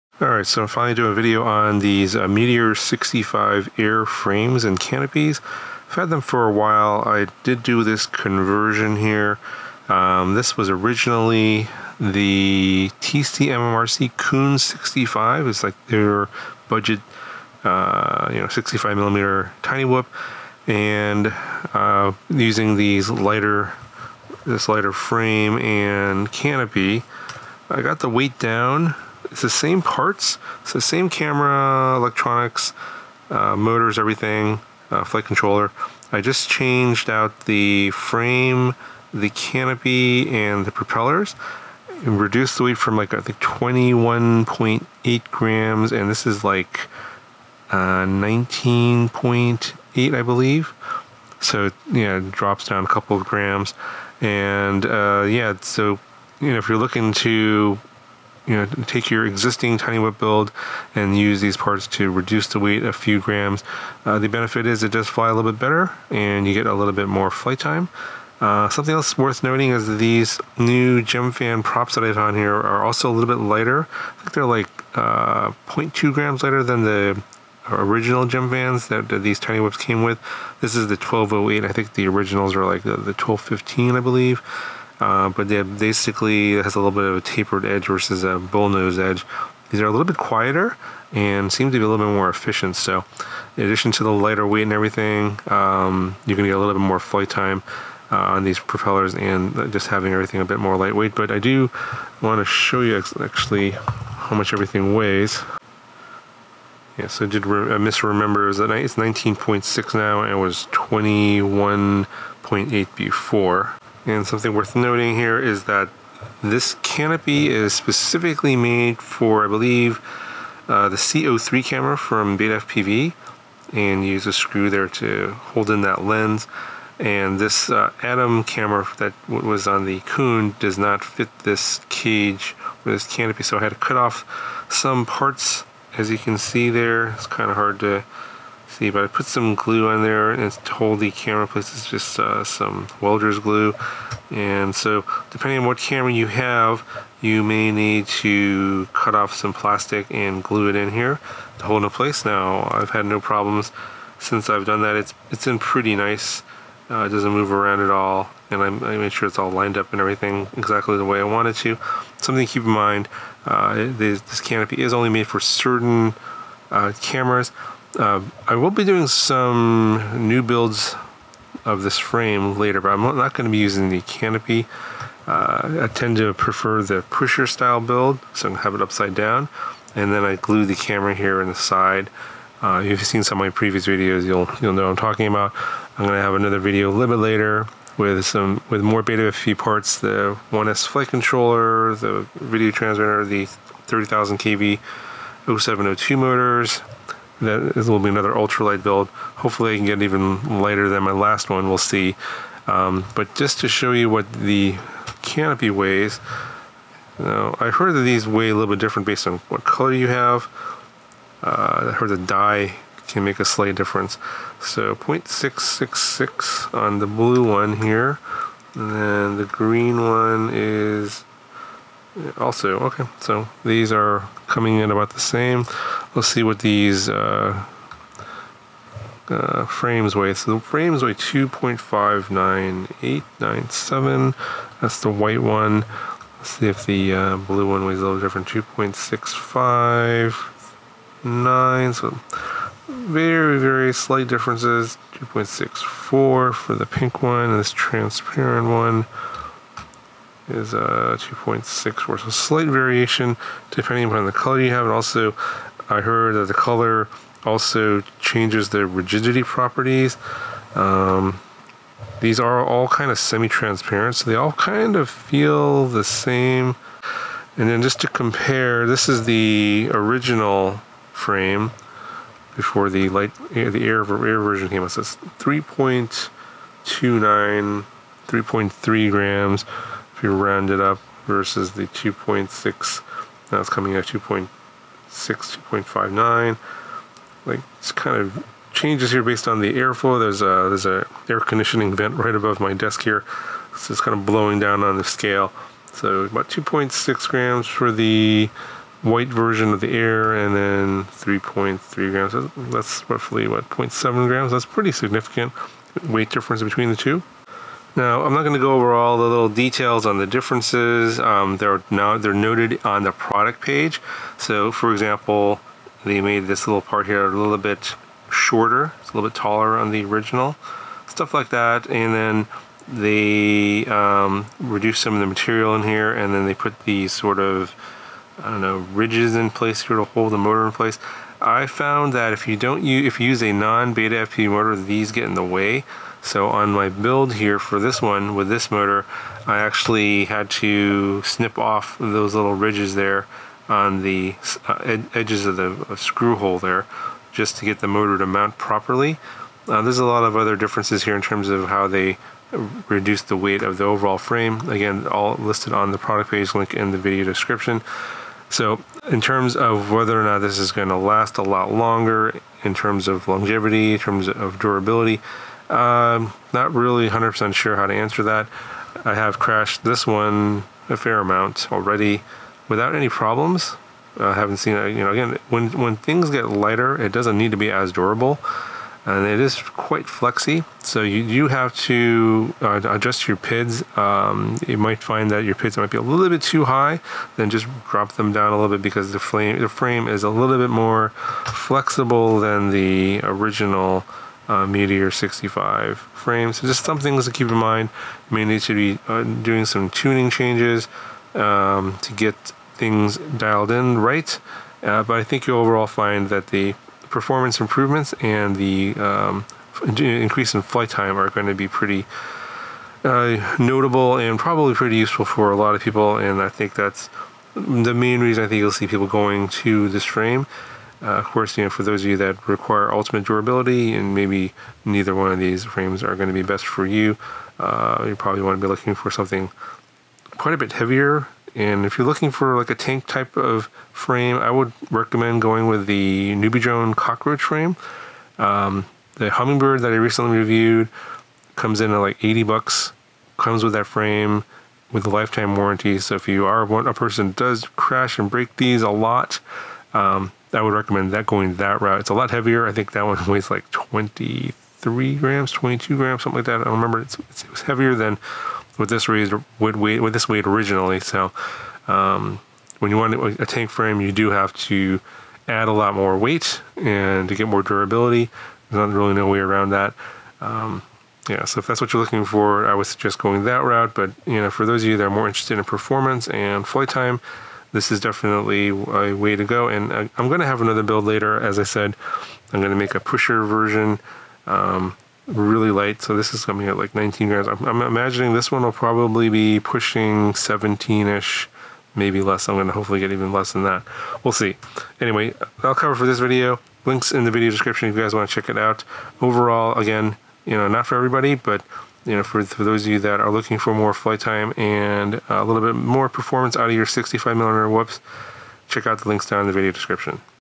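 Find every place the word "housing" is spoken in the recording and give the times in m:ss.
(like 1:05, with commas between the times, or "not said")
not said.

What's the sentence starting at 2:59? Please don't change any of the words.
And then I glue the camera here in the side.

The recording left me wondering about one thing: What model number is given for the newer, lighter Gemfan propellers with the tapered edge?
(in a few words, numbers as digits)
1208.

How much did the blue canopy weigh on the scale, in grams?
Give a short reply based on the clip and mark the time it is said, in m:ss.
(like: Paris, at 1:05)
0.666, at 3:34.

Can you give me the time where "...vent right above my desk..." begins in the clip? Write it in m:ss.
4:51.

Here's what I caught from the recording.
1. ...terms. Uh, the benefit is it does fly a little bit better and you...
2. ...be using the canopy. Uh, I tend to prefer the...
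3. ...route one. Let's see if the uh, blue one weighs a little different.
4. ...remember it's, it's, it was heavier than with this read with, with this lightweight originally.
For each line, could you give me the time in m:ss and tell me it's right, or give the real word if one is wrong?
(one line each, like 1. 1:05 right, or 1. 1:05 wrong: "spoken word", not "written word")
1. 1:03 wrong: "grams", not "terms"
2. 2:53 right
3. 3:55 wrong: "white", not "route"
4. 7:36 wrong: "weight", not "lightweight".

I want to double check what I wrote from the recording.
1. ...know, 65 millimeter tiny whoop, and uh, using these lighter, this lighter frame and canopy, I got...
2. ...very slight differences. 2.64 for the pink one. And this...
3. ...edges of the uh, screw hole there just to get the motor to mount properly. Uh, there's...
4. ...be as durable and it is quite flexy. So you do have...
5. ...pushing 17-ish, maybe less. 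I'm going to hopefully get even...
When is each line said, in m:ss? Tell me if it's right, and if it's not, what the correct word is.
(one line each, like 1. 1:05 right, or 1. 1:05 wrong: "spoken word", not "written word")
1. 0:18 right
2. 4:03 right
3. 5:45 right
4. 6:17 right
5. 8:09 right.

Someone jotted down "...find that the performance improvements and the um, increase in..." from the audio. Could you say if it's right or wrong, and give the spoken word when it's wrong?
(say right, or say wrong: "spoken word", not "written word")
right.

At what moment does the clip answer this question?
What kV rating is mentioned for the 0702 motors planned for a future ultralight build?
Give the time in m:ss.
3:13.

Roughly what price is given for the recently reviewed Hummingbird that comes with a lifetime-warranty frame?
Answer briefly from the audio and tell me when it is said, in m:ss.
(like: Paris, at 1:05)
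80 bucks, at 7:22.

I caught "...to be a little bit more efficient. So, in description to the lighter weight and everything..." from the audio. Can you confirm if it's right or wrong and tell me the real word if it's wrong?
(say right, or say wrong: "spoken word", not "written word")
wrong: "addition", not "description".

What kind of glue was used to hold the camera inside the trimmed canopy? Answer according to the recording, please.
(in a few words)
welder's glue.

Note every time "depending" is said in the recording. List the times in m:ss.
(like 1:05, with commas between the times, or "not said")
2:25, 4:13.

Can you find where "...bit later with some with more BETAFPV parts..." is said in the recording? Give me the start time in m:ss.
3:07.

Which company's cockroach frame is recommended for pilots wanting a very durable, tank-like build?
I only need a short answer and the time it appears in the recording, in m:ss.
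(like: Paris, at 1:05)
NewBeeDrone, at 7:16.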